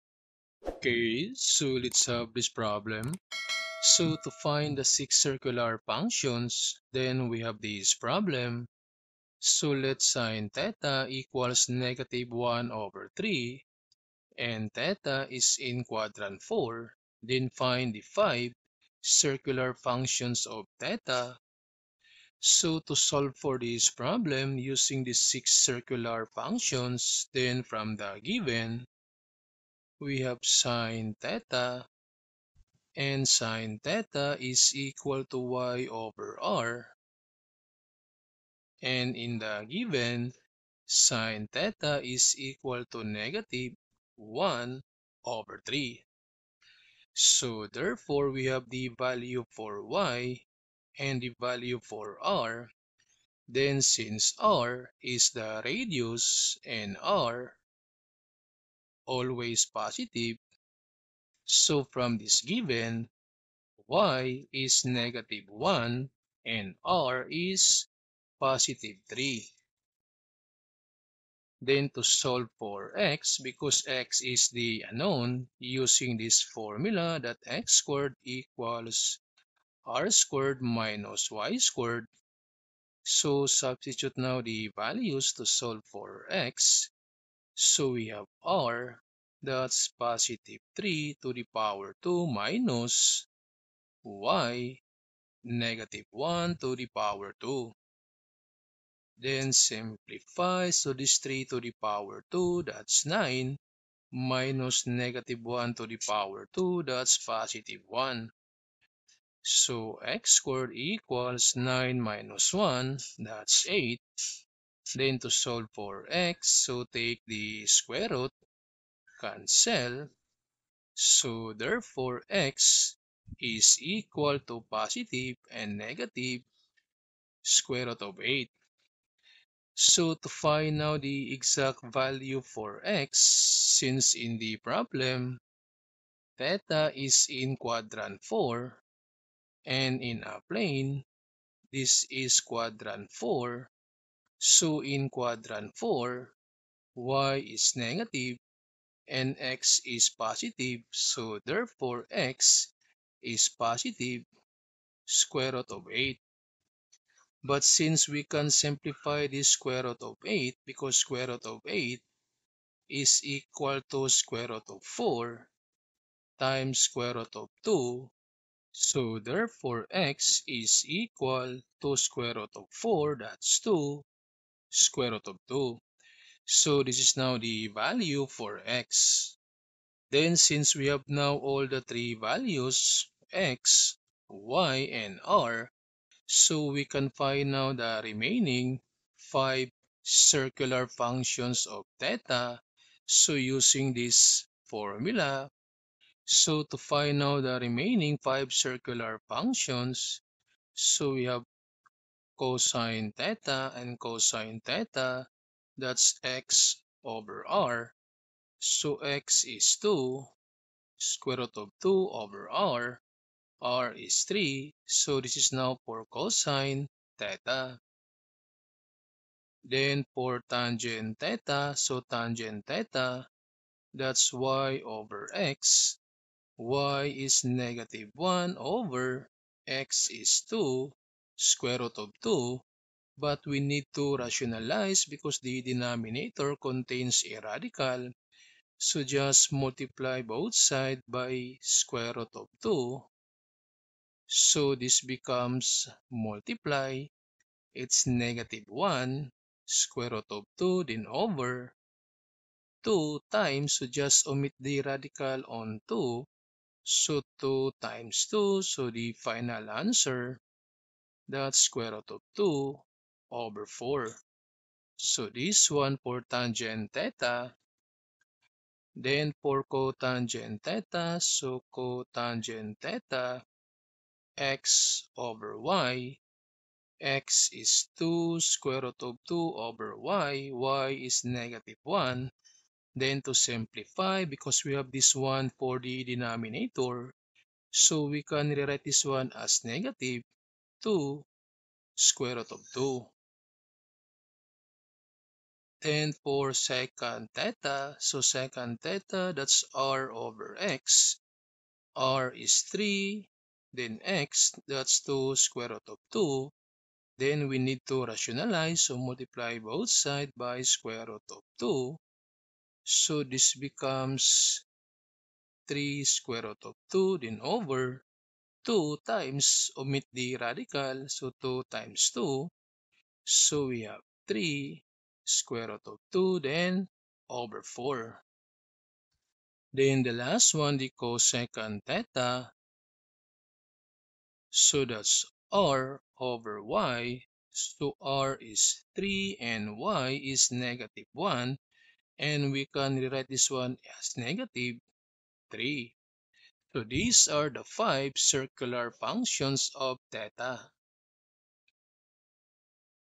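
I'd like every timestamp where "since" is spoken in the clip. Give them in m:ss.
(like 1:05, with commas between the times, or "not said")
0:53, 2:13, 2:37, 3:00.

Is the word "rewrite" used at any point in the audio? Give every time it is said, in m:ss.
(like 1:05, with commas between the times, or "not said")
4:48, 5:43.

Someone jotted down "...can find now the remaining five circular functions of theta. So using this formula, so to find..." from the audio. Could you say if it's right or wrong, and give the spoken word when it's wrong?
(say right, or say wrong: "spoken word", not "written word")
right.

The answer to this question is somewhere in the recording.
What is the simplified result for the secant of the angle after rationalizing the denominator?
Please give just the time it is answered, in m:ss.
5:24.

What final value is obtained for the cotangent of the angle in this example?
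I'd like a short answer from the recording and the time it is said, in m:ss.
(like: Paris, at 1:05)
-2√2, at 4:49.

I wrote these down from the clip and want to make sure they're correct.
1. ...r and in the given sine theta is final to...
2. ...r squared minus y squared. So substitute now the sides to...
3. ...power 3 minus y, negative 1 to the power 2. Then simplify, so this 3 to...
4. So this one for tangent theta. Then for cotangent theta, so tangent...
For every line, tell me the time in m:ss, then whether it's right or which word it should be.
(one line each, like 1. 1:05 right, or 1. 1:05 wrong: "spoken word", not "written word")
1. 0:36 wrong: "equal", not "final"
2. 1:19 wrong: "values", not "sides"
3. 1:31 wrong: "2", not "3"
4. 4:24 wrong: "cotangent", not "tangent".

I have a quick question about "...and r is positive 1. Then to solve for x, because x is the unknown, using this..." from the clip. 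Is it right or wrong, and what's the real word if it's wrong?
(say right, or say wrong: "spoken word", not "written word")
wrong: "3", not "1".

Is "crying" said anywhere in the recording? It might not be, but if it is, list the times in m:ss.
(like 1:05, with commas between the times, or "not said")
not said.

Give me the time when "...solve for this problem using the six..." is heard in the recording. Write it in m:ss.
0:22.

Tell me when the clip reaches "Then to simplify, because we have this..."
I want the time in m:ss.
4:42.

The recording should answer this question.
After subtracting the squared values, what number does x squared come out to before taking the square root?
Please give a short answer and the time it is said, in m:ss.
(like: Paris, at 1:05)
8, at 1:53.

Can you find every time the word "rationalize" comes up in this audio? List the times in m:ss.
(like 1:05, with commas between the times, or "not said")
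3:54, 5:08.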